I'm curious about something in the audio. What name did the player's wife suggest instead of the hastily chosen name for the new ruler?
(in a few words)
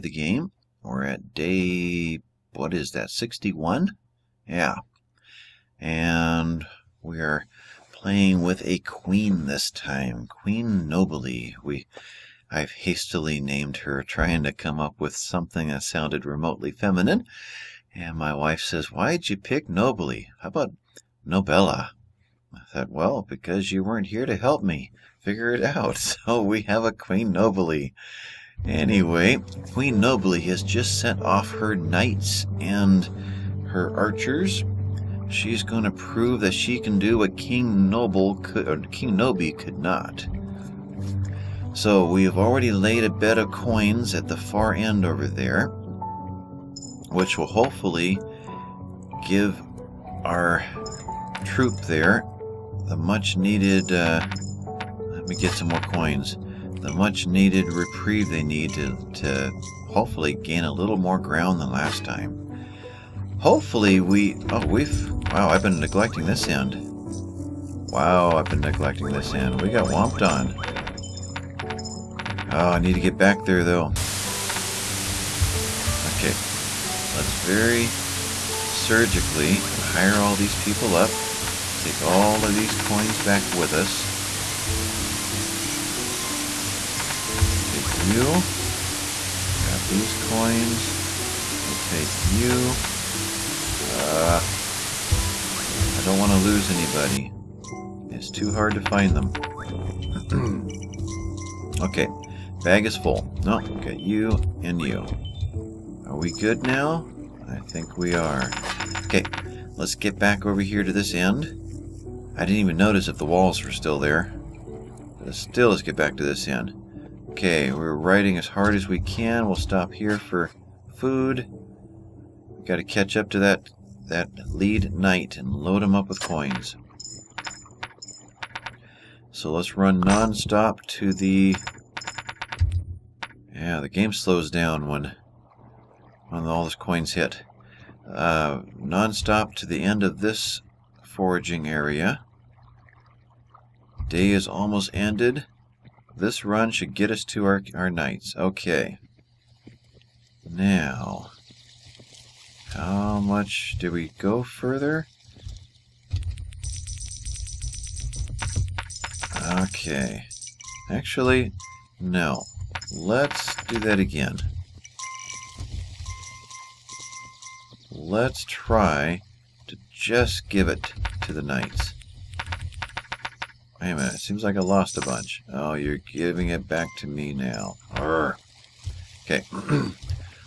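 Nobella.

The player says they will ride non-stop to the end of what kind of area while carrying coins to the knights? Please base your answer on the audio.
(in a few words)
foraging area.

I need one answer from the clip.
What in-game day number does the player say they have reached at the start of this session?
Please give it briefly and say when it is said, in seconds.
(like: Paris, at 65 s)
61, at 3 s.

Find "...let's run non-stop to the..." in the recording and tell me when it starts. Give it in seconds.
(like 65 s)
129 s.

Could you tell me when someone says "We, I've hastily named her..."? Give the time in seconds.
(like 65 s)
11 s.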